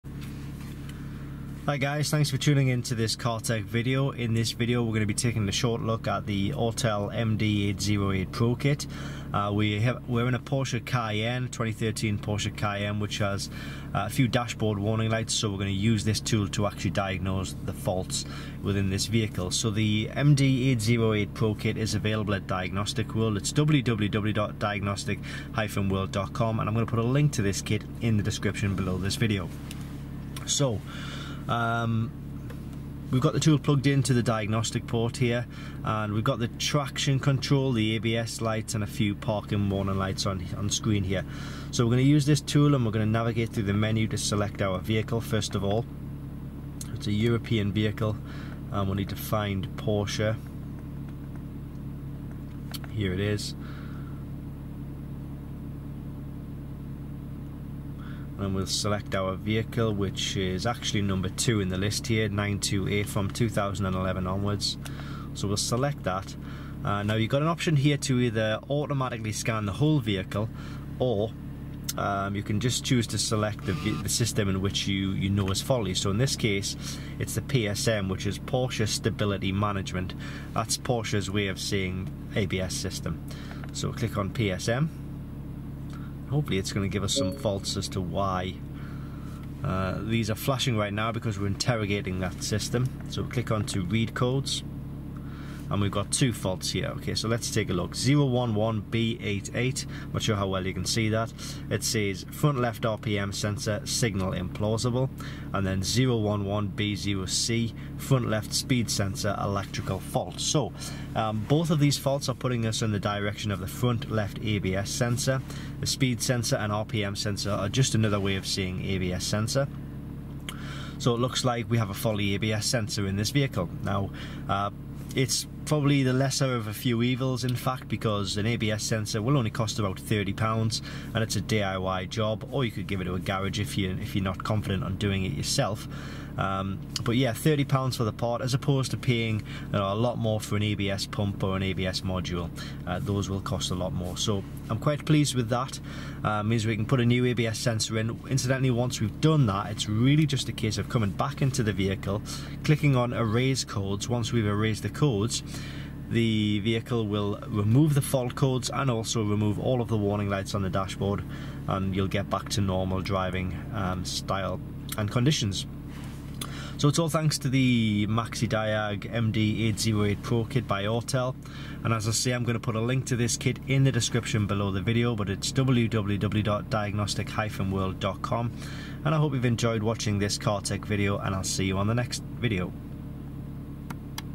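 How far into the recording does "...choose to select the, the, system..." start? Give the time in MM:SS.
01:12.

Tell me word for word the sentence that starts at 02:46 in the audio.
So it's all thanks to the MaxiDiag MD808 Pro kit by Autel.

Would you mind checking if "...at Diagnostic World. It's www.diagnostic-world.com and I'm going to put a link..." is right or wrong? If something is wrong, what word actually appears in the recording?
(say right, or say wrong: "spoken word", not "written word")
right.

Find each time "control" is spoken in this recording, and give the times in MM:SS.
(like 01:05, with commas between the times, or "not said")
00:37.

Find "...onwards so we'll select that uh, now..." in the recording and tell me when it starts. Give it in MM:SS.
01:04.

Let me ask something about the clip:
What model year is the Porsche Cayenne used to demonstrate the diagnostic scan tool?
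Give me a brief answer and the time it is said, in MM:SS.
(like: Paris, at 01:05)
2013, at 00:11.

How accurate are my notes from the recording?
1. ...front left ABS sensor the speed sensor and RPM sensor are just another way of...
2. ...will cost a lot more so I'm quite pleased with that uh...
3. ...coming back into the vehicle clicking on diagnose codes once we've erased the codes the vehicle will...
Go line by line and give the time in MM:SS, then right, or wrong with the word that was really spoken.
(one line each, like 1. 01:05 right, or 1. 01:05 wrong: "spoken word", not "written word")
1. 01:53 right
2. 02:23 right
3. 02:30 wrong: "erase", not "diagnose".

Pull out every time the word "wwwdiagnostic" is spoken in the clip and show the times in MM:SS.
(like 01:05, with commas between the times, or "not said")
00:23, 02:55.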